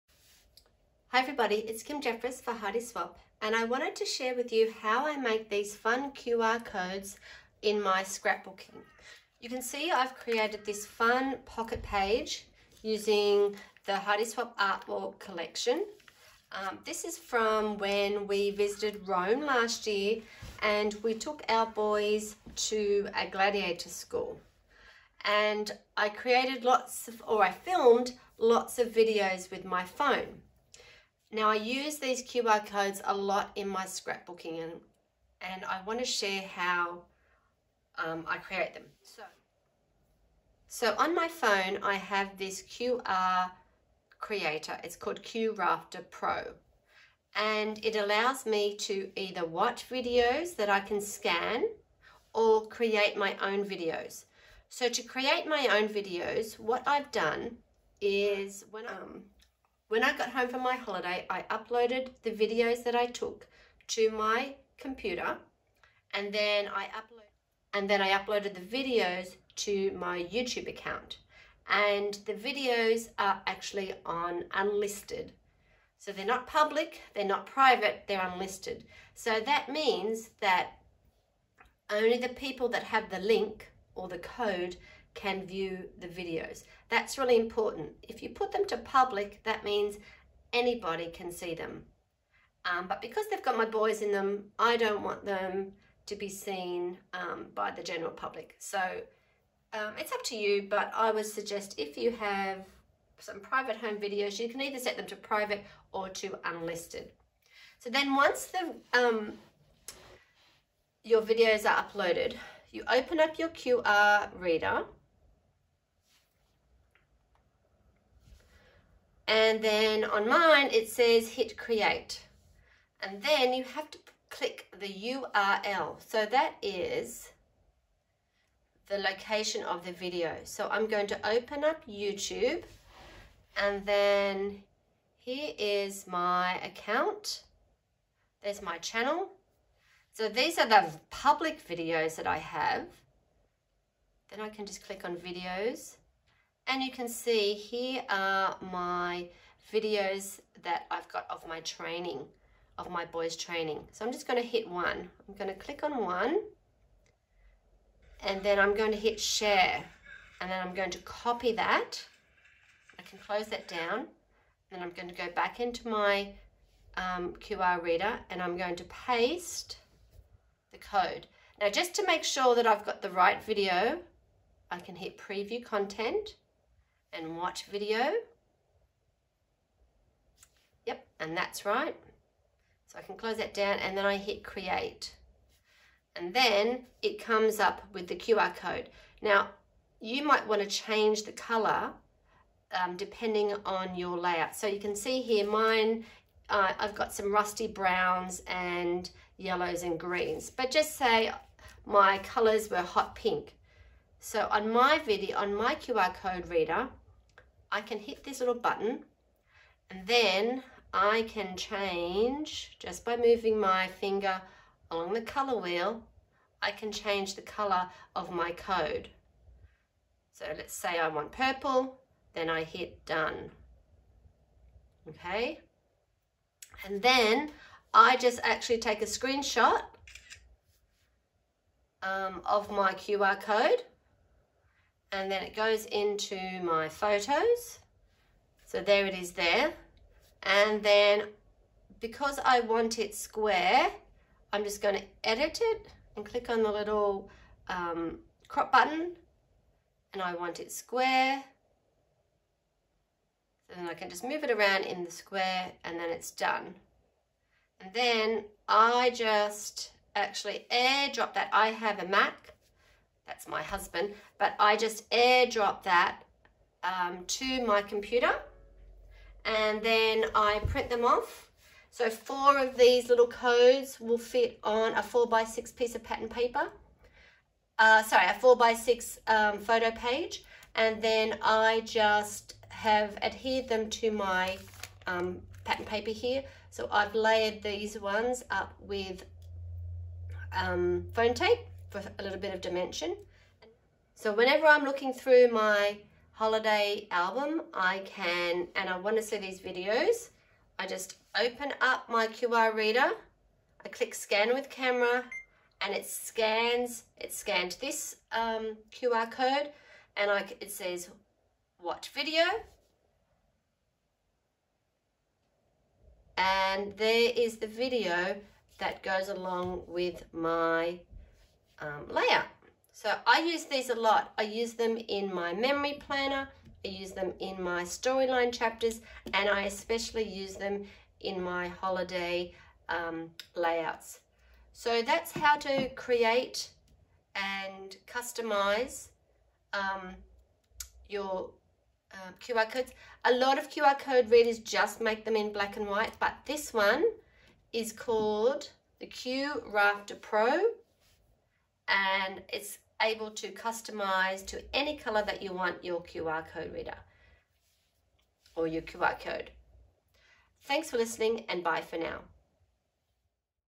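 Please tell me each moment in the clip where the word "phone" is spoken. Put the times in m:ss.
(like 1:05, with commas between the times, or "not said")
0:29, 0:41.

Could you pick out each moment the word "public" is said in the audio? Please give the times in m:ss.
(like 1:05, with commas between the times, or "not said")
1:16, 1:28, 1:38, 2:21.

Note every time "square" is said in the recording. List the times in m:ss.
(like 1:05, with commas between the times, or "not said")
4:03, 4:10, 4:15.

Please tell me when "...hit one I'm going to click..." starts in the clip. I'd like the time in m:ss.
2:34.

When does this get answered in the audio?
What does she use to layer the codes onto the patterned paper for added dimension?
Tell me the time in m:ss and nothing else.
4:51.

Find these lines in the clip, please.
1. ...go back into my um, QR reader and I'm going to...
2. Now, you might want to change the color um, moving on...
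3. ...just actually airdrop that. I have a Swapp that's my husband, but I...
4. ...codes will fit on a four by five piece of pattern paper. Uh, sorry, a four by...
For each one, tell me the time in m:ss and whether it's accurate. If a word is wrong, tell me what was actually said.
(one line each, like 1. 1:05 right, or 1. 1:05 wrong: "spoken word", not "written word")
1. 2:45 right
2. 3:09 wrong: "depending", not "moving"
3. 4:19 wrong: "Mac", not "Swapp"
4. 4:33 wrong: "six", not "five".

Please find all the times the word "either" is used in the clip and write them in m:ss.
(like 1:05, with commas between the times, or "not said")
0:49, 1:44.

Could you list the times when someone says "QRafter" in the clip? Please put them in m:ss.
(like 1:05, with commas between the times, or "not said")
0:45, 5:49.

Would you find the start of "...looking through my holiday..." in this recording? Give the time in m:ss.
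4:54.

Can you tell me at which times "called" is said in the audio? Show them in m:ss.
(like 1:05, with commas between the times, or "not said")
0:44, 5:47.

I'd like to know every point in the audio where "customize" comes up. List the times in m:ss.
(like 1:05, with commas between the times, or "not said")
5:38, 5:53.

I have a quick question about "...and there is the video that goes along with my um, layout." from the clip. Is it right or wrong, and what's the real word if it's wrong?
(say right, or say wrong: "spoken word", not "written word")
right.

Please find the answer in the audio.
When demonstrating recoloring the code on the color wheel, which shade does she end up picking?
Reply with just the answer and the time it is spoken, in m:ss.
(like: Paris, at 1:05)
Purple, at 3:41.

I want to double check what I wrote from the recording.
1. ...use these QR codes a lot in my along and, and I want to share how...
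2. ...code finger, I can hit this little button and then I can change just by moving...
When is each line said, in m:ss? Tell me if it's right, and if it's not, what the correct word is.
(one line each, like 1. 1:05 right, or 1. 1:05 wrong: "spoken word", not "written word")
1. 0:31 wrong: "scrapbooking", not "along"
2. 3:26 wrong: "reader", not "finger".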